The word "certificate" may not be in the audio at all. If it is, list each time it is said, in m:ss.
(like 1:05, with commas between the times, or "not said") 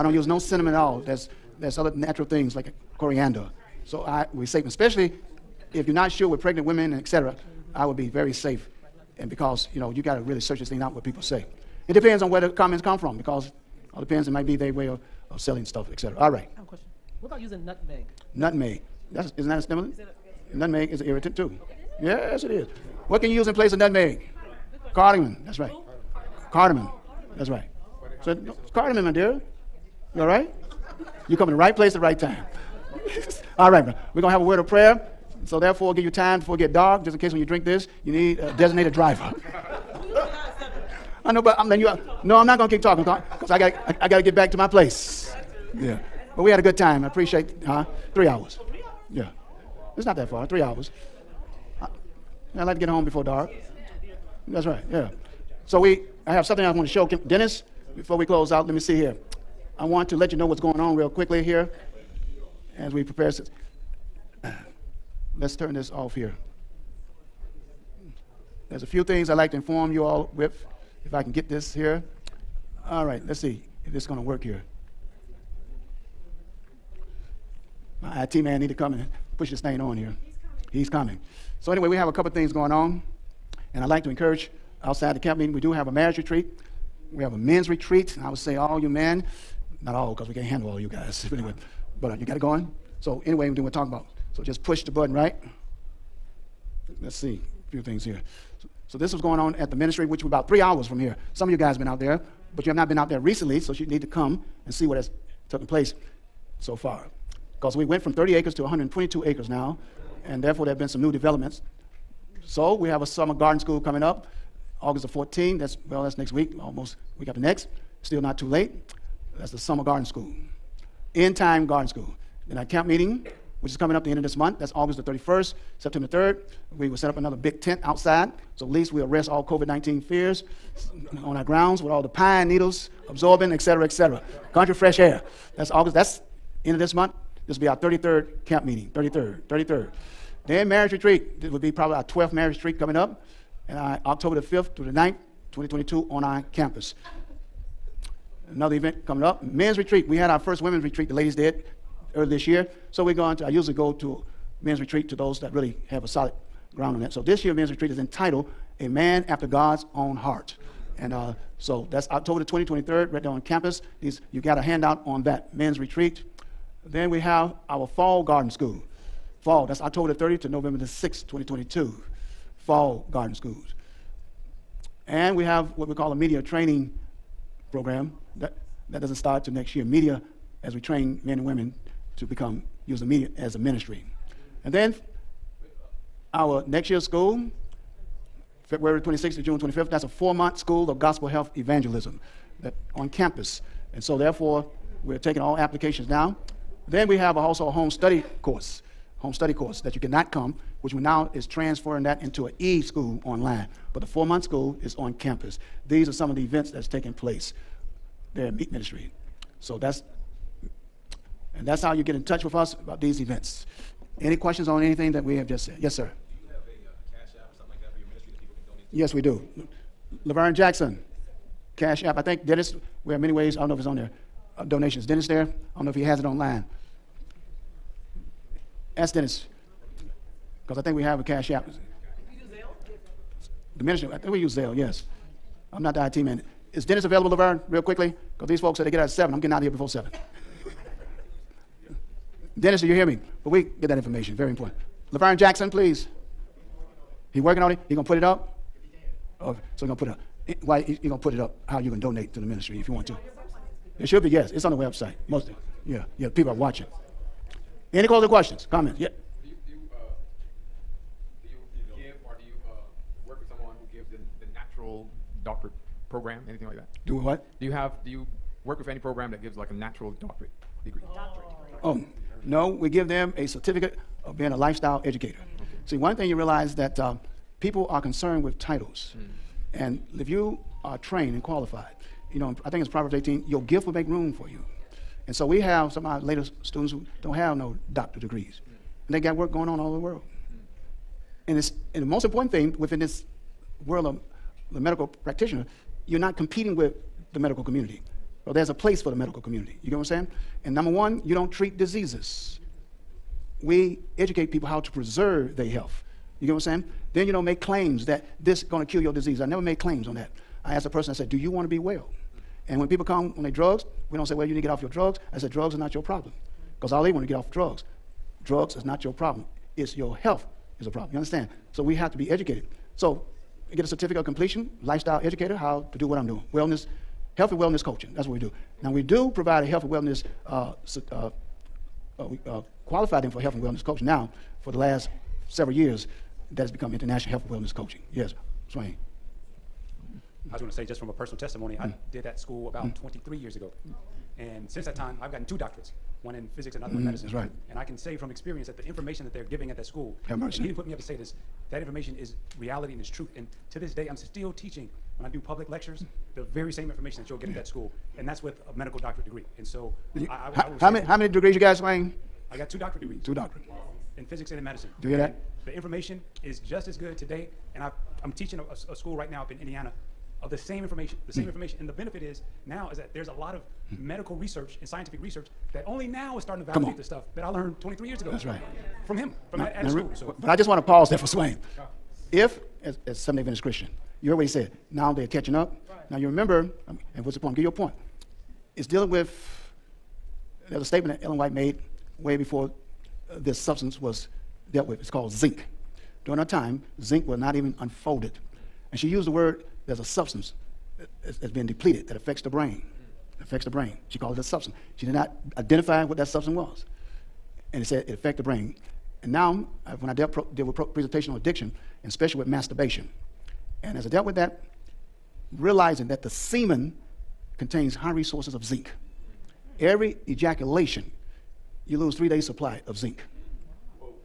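4:33, 5:23.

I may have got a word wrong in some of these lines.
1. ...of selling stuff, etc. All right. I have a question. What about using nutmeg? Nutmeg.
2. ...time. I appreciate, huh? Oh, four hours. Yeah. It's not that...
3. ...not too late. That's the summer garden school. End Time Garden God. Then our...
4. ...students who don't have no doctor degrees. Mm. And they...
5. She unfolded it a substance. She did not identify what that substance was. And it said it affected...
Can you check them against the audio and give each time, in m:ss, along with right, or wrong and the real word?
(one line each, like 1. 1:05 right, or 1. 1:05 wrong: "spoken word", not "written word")
1. 0:15 right
2. 0:46 wrong: "three", not "four"
3. 1:58 wrong: "School", not "God"
4. 4:46 right
5. 6:44 wrong: "called", not "unfolded".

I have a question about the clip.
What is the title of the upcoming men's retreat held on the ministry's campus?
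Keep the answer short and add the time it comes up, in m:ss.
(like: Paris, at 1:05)
A man after God's own heart, at 2:38.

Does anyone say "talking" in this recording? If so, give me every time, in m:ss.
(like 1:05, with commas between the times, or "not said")
0:42, 1:33.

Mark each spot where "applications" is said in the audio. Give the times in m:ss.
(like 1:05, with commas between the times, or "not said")
3:15.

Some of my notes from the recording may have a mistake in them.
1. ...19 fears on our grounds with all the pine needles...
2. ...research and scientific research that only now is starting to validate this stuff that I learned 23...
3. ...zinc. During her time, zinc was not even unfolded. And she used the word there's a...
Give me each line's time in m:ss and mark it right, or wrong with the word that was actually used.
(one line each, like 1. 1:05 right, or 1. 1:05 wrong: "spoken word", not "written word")
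1. 2:09 right
2. 6:14 right
3. 6:35 right.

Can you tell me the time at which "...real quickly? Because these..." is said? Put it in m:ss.
3:57.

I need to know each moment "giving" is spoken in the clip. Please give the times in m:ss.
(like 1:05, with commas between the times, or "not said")
5:49.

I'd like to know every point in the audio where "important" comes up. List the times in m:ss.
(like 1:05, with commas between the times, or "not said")
4:04, 4:52.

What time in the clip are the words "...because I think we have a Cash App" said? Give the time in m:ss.
3:50.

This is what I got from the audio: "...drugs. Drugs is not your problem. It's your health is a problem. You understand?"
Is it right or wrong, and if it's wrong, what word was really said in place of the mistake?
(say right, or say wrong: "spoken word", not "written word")
right.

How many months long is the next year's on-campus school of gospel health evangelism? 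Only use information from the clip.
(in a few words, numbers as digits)
4 months.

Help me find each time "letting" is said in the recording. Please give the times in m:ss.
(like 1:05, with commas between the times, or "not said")
0:41.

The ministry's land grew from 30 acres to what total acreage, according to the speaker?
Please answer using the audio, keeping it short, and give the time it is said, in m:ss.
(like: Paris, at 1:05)
122 acres, at 1:48.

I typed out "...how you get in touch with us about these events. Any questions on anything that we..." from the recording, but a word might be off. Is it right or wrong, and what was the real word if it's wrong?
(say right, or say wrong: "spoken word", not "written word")
right.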